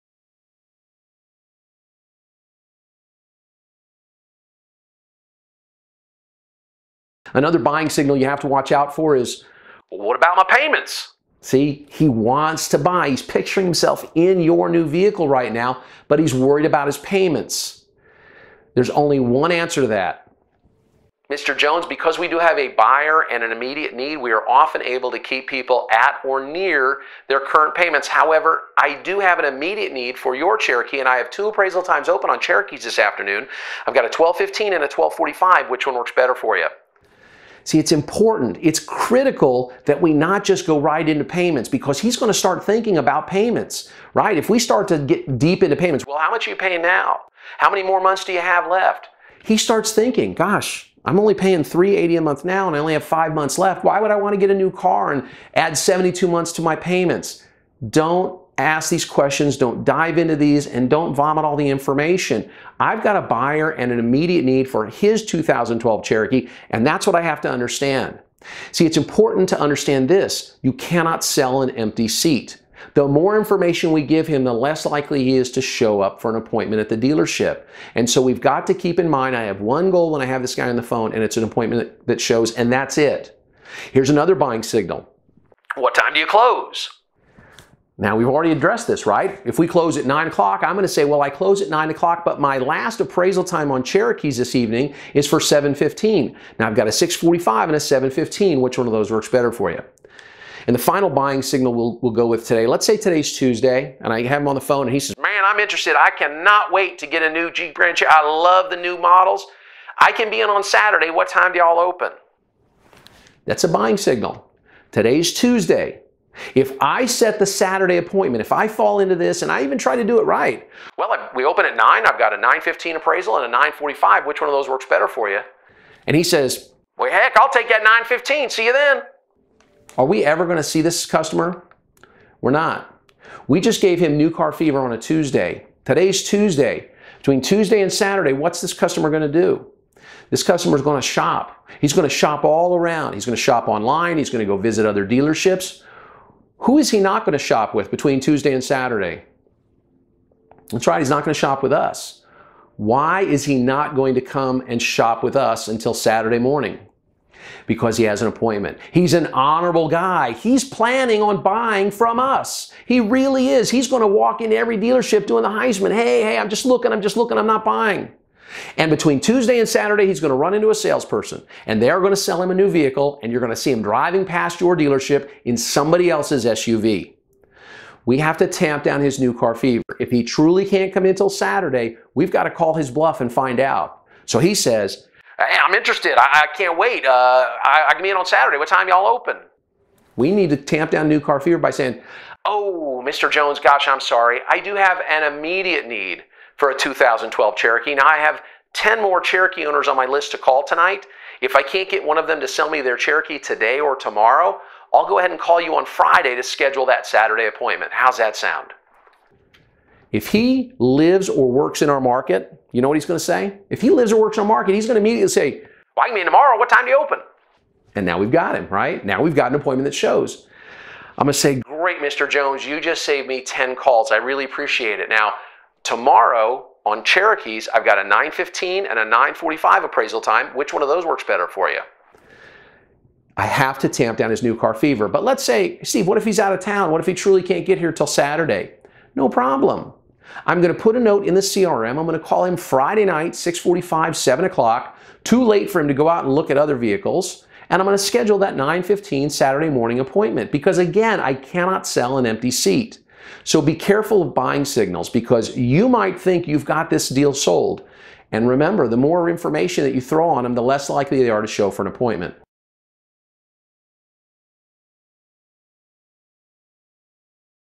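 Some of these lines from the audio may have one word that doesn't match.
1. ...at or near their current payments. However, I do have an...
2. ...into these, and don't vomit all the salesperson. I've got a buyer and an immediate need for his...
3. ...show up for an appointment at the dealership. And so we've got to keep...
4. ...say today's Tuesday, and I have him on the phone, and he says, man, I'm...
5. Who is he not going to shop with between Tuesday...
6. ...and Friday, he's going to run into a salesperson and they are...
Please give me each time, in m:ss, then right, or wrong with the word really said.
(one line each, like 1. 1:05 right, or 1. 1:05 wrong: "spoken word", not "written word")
1. 0:25 right
2. 1:00 wrong: "information", not "salesperson"
3. 1:15 right
4. 1:42 right
5. 2:26 right
6. 2:49 wrong: "Saturday", not "Friday".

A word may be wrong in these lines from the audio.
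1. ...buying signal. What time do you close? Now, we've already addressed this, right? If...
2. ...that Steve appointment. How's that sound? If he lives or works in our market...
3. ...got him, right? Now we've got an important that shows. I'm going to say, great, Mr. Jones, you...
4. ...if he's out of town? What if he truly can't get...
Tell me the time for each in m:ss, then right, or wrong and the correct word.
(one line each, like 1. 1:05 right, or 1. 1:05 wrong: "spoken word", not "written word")
1. 1:24 right
2. 3:26 wrong: "Saturday", not "Steve"
3. 3:38 wrong: "appointment", not "important"
4. 3:56 right.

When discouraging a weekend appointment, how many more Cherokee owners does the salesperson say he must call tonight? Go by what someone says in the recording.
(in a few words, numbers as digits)
10.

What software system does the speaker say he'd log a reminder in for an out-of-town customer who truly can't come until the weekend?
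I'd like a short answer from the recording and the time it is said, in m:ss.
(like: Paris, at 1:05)
CRM, at 4:01.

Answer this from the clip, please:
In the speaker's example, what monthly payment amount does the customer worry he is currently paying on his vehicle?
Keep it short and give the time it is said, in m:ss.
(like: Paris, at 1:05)
380, at 0:51.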